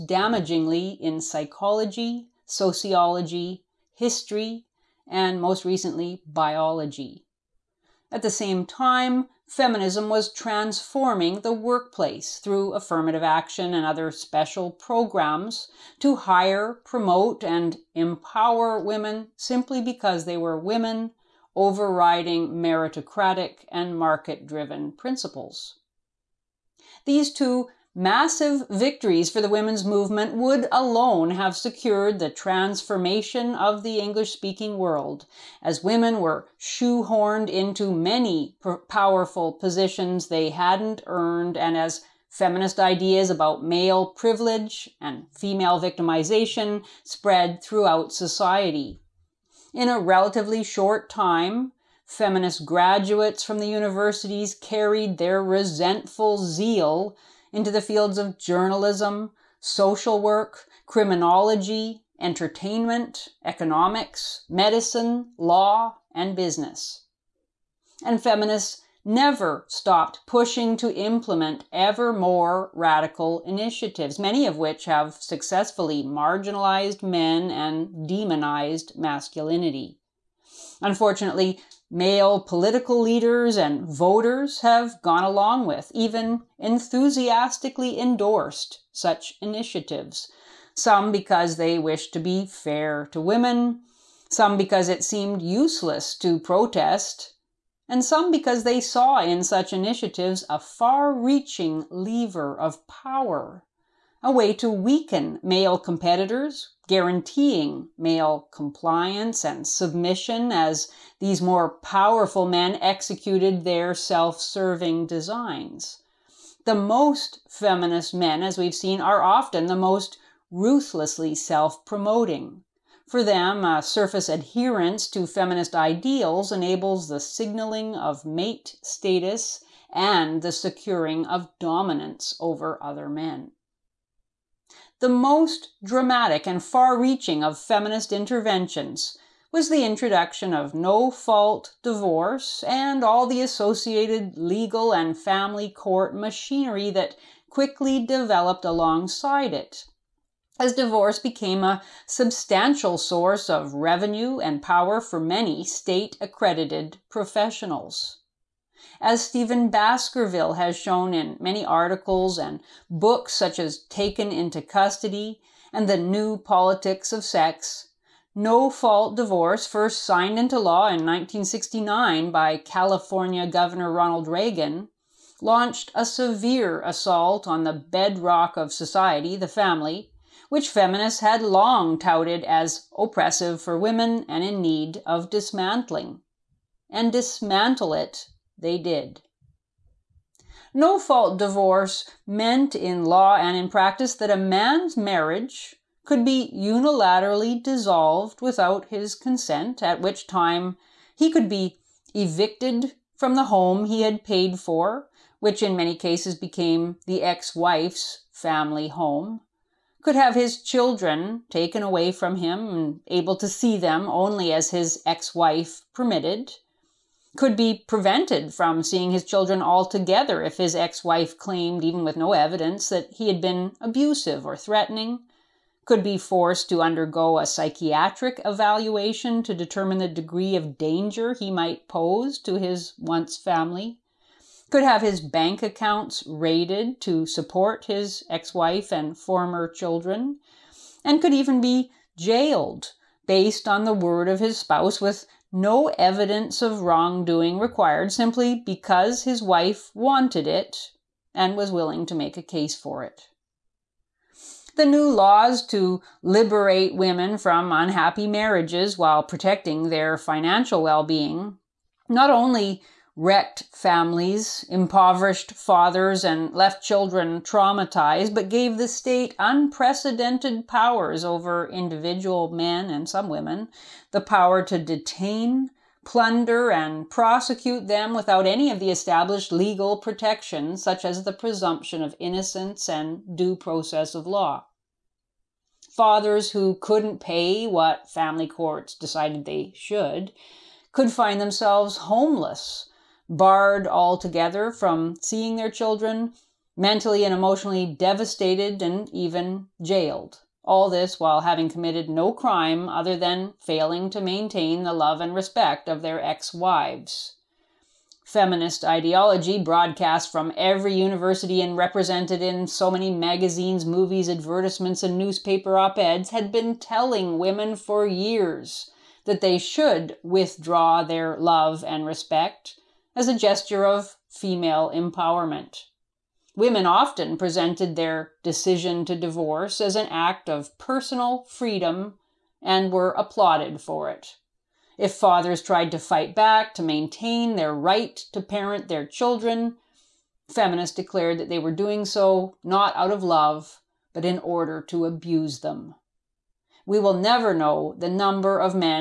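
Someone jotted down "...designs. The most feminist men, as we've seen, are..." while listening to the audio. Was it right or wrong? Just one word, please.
right.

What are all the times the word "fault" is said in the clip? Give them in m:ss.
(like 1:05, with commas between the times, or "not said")
2:21, 2:48, 3:10.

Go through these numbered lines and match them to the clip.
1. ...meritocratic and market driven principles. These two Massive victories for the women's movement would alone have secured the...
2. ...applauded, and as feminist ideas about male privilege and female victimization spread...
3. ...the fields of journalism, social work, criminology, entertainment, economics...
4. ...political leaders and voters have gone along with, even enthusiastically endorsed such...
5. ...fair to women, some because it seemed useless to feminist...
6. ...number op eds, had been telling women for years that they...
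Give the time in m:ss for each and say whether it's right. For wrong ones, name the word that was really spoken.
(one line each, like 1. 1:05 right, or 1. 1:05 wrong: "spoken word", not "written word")
1. 0:22 right
2. 0:41 wrong: "earned", not "applauded"
3. 0:57 right
4. 1:22 right
5. 1:32 wrong: "protest", not "feminist"
6. 5:15 wrong: "newspaper", not "number".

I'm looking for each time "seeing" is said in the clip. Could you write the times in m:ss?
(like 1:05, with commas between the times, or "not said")
3:38, 4:55.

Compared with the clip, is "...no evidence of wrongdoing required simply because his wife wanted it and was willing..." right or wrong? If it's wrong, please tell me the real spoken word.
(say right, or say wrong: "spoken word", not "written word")
right.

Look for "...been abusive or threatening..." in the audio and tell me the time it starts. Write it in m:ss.
3:43.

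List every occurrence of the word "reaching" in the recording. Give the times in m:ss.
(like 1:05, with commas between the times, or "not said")
1:41, 2:16.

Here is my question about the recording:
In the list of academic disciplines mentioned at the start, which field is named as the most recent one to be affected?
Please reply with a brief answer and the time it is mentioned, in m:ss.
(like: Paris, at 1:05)
Biology, at 0:06.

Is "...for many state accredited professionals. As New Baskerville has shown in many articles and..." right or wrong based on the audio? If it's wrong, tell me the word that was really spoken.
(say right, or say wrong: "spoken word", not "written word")
wrong: "Stephen", not "New".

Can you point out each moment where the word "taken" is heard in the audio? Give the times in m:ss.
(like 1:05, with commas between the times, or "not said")
2:43, 3:31.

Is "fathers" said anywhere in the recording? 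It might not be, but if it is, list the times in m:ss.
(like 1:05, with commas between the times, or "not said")
4:25, 4:45, 5:35.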